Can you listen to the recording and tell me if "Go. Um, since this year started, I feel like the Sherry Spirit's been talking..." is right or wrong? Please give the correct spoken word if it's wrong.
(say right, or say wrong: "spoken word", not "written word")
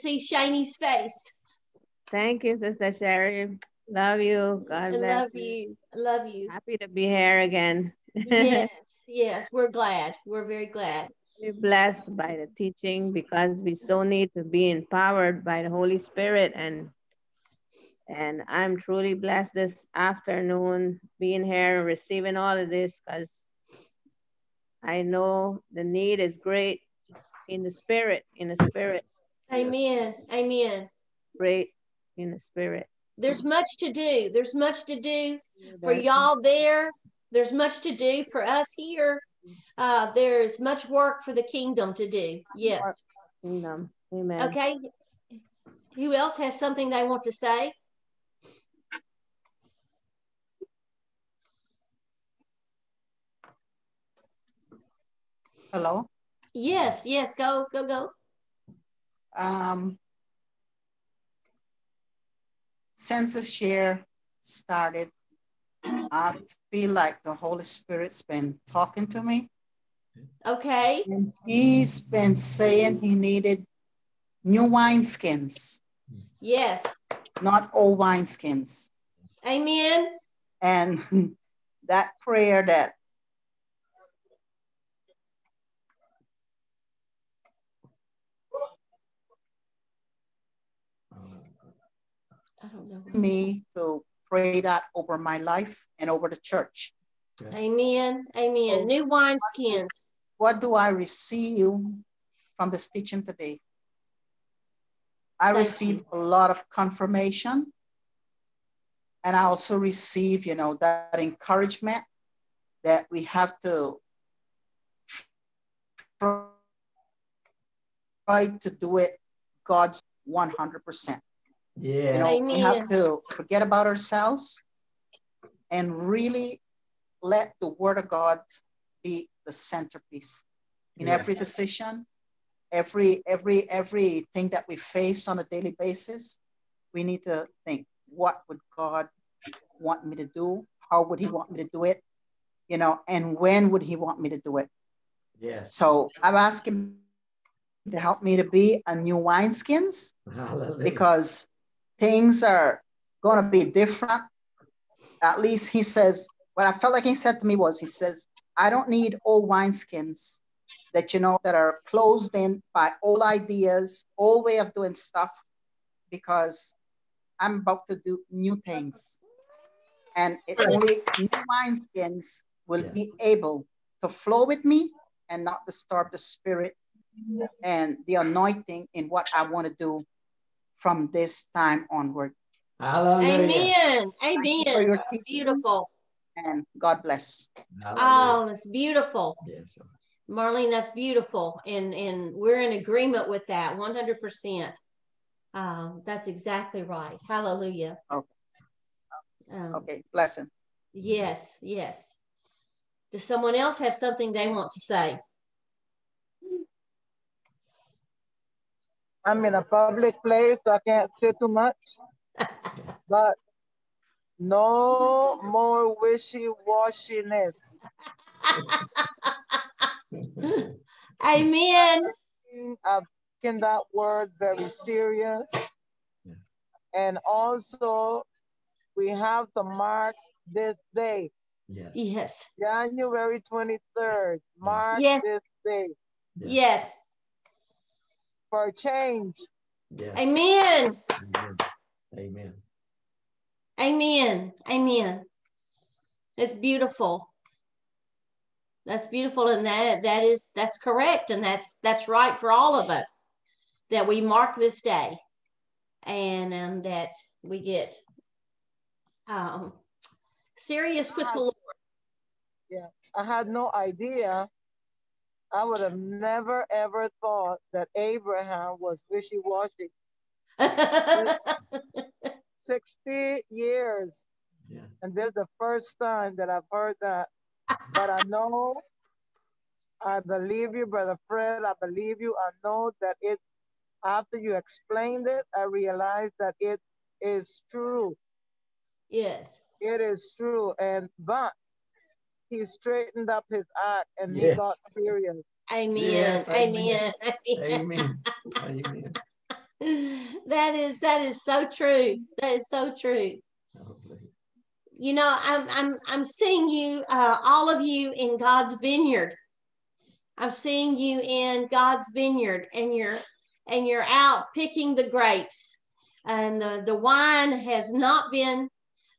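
wrong: "Holy", not "Sherry".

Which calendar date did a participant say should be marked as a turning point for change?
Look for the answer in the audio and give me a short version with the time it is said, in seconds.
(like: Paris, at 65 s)
January 23rd, at 232 s.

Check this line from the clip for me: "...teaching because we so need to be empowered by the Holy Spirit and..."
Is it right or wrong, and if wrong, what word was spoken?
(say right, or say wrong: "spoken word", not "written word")
right.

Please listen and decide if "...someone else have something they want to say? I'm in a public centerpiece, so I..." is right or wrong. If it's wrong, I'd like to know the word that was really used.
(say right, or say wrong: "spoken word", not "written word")
wrong: "place", not "centerpiece".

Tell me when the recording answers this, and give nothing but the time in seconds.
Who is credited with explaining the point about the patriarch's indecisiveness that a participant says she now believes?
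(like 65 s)
280 s.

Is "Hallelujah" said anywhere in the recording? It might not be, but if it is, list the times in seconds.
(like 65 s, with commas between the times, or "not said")
182 s, 187 s, 197 s.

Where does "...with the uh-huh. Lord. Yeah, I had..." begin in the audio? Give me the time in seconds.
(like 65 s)
261 s.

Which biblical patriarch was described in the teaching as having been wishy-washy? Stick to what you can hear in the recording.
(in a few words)
Abraham.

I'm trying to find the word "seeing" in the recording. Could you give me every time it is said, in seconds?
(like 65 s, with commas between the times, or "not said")
306 s, 310 s.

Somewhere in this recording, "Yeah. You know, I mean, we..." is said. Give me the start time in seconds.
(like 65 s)
121 s.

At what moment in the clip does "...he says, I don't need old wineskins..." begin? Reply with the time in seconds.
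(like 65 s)
157 s.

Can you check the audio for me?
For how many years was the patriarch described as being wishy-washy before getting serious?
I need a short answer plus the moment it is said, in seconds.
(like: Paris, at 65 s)
60, at 272 s.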